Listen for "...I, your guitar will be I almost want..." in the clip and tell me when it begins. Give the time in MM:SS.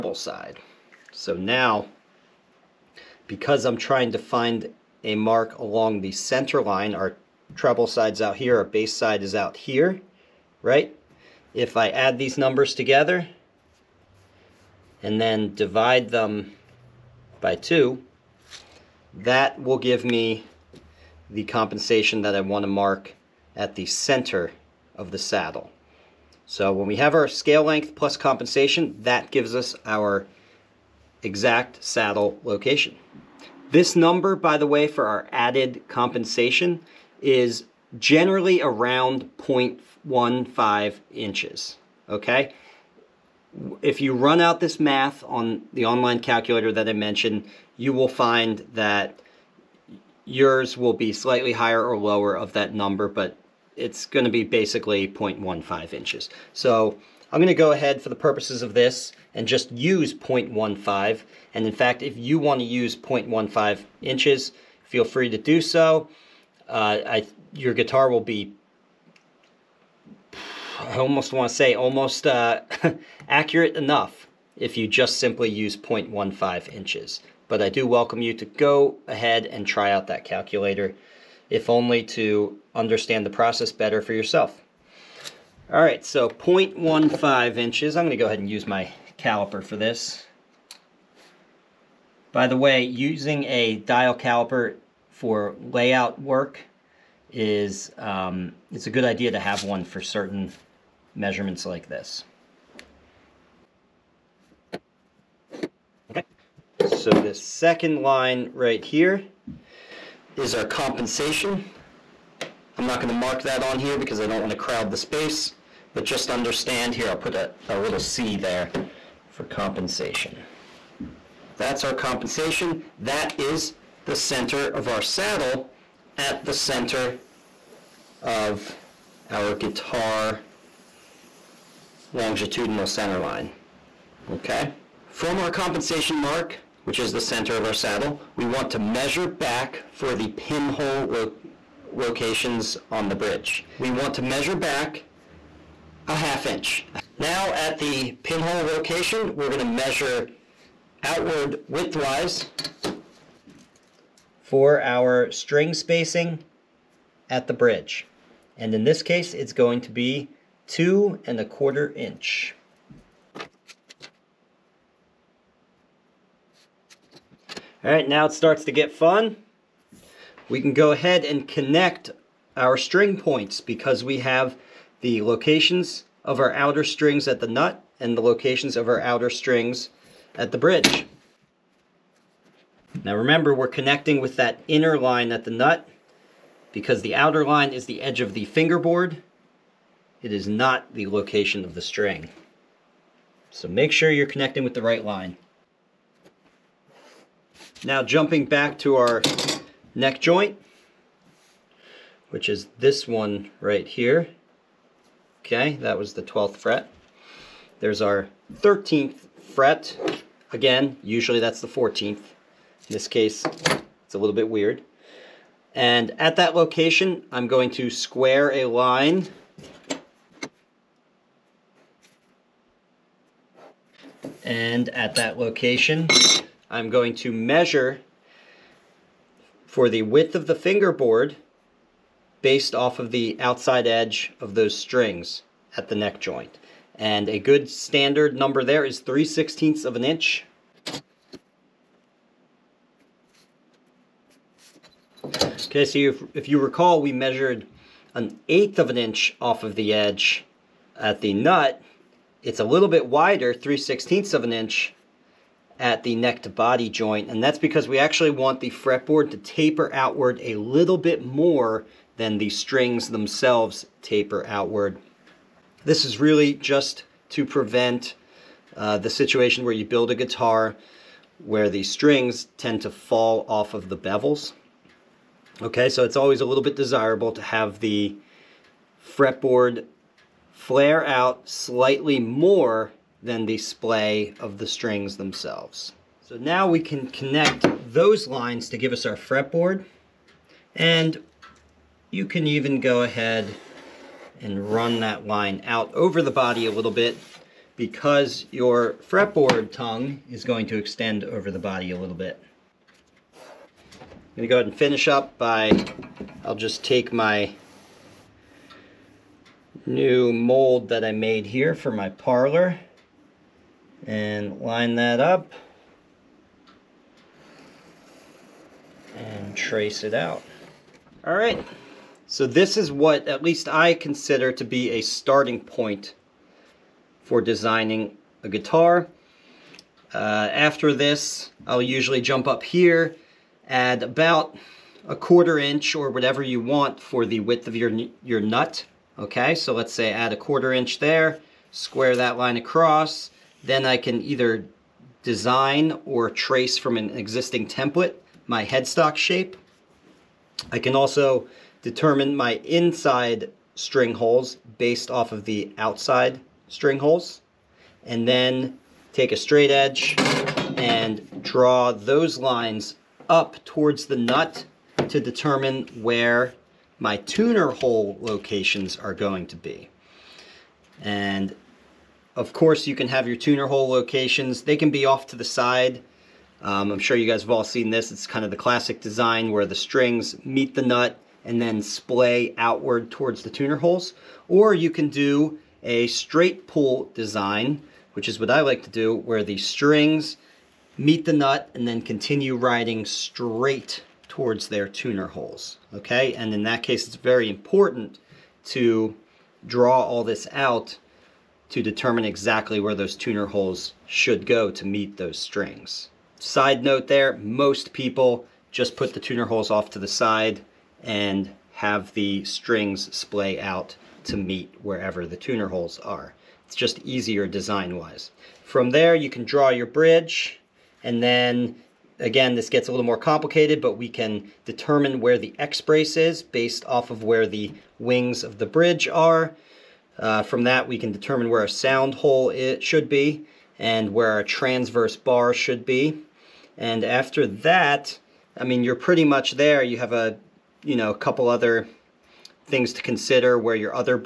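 01:07.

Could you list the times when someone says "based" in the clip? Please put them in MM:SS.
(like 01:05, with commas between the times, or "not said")
03:52, 05:54, 07:06.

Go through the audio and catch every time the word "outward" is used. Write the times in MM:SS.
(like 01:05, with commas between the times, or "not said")
02:31, 04:19, 04:24, 06:22.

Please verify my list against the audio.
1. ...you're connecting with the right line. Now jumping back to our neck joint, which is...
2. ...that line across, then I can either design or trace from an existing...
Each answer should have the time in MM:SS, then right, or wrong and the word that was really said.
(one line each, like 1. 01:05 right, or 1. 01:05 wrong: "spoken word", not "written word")
1. 03:14 right
2. 05:42 right.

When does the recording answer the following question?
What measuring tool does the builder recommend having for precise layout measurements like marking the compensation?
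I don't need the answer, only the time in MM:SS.
01:33.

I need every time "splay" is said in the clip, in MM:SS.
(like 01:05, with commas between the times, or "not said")
04:43, 06:21, 06:53.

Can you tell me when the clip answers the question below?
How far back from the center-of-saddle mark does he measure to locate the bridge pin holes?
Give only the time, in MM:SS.
02:26.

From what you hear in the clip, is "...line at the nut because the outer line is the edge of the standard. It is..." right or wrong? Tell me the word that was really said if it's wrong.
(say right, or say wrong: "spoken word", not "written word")
wrong: "fingerboard", not "standard".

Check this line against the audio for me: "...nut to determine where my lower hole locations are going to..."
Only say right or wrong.
wrong.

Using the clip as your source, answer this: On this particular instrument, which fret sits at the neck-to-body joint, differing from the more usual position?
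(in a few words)
13th fret.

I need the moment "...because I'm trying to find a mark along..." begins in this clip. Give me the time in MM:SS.
00:03.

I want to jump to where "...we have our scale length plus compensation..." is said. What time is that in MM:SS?
00:26.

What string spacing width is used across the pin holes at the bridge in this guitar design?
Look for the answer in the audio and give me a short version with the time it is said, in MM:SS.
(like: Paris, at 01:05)
2 1/4 inches, at 02:40.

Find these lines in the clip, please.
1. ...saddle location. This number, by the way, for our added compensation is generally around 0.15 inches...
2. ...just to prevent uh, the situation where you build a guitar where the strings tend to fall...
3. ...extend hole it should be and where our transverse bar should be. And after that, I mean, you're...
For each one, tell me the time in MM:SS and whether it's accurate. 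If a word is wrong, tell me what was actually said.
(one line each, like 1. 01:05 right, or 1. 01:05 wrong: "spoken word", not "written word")
1. 00:31 right
2. 04:26 right
3. 07:11 wrong: "sound", not "extend".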